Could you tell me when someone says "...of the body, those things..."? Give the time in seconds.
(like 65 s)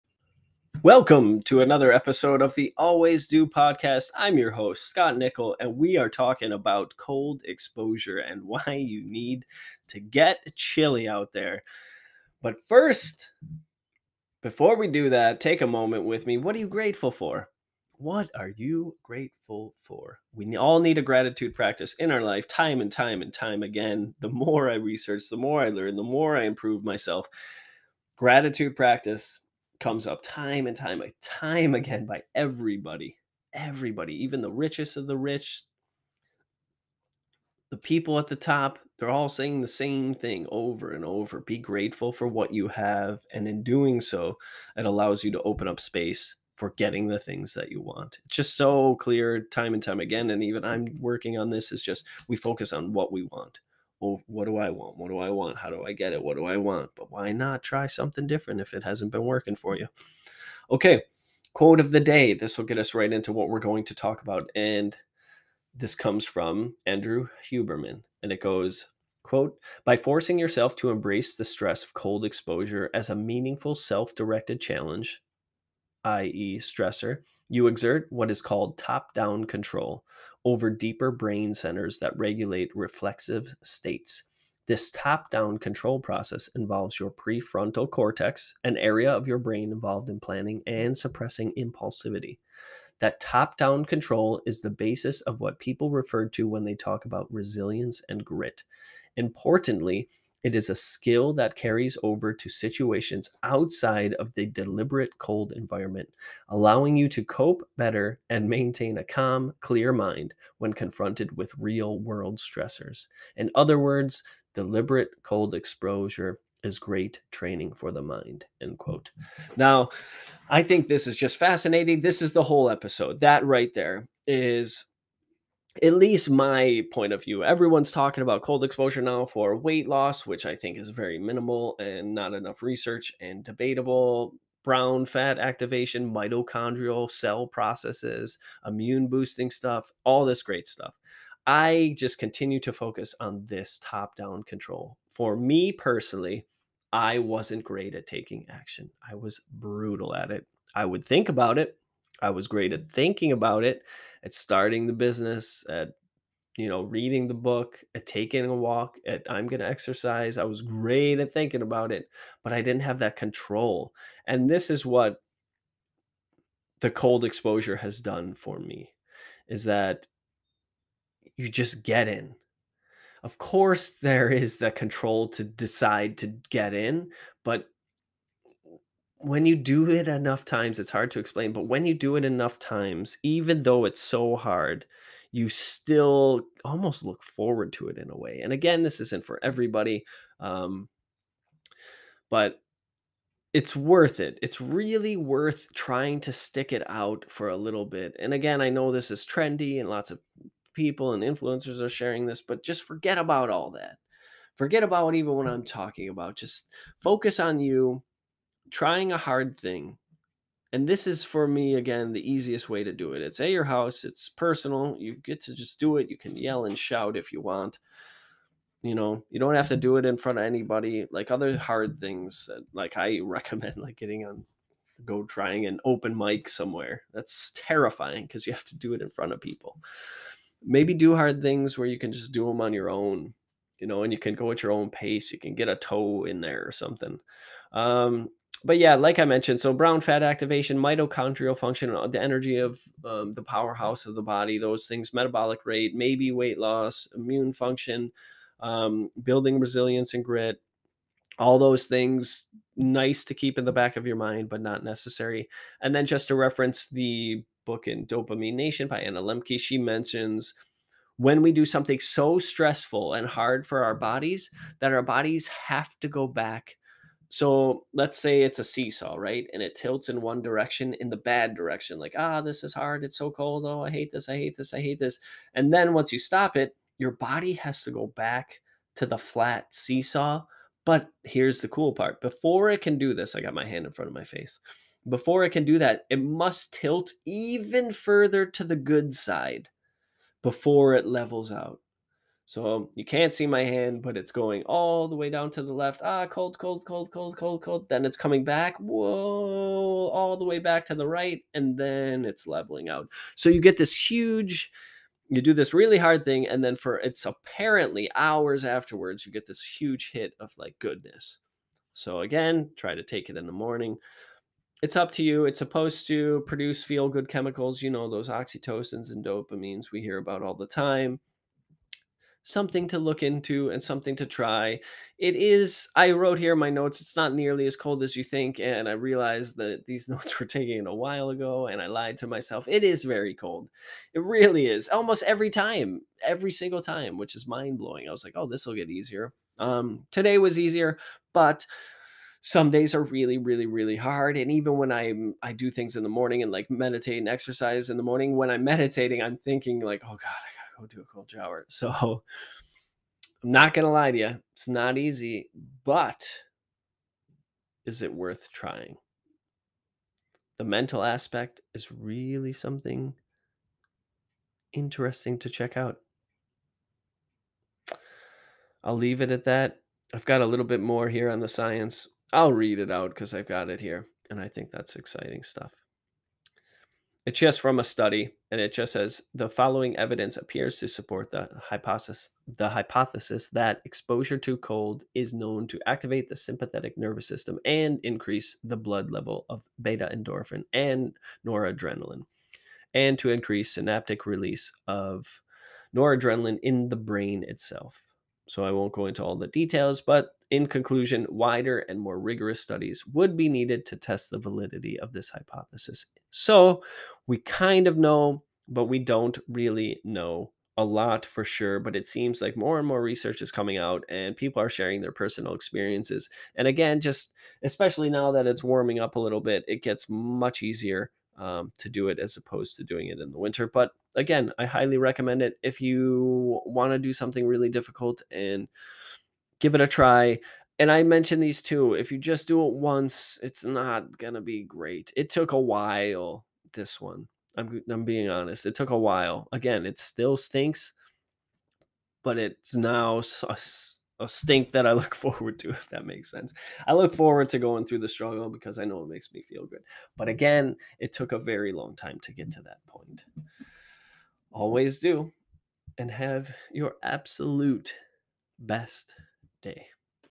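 244 s.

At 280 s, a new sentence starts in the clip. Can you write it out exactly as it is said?
But here's the cool part before it can do this, I got my hand in front of my face.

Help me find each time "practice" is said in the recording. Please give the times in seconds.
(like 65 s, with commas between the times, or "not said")
21 s, 28 s.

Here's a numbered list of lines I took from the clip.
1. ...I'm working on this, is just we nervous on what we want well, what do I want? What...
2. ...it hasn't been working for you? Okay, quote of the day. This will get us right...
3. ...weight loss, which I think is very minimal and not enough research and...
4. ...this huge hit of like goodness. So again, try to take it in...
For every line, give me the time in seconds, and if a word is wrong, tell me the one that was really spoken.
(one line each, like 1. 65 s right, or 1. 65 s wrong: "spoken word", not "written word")
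1. 50 s wrong: "focus", not "nervous"
2. 58 s right
3. 129 s right
4. 309 s right.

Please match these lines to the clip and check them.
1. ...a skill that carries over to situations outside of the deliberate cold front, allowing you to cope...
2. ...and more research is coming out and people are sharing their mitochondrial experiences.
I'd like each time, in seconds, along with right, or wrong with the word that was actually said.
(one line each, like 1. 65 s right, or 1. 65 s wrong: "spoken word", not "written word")
1. 100 s wrong: "environment", not "front"
2. 412 s wrong: "personal", not "mitochondrial".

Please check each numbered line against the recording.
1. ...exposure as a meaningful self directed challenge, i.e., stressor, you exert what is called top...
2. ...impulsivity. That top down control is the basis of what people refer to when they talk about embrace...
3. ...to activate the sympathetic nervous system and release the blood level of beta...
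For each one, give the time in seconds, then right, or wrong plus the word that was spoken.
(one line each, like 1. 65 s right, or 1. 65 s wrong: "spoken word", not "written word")
1. 72 s right
2. 91 s wrong: "resilience", not "embrace"
3. 385 s wrong: "increase", not "release".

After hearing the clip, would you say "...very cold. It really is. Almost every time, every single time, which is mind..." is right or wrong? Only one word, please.
right.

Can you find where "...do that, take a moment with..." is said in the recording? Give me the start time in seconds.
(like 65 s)
14 s.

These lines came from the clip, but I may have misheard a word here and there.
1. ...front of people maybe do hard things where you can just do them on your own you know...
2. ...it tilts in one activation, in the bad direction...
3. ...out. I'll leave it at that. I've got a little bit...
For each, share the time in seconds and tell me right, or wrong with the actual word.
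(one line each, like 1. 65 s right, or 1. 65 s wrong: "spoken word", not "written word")
1. 229 s right
2. 269 s wrong: "direction", not "activation"
3. 365 s right.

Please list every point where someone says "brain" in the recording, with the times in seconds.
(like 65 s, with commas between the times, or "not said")
81 s, 89 s, 396 s.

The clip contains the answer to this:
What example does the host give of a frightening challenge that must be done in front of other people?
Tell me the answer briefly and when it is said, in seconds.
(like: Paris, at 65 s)
open mic, at 225 s.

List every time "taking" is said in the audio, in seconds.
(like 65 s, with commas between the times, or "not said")
148 s, 158 s.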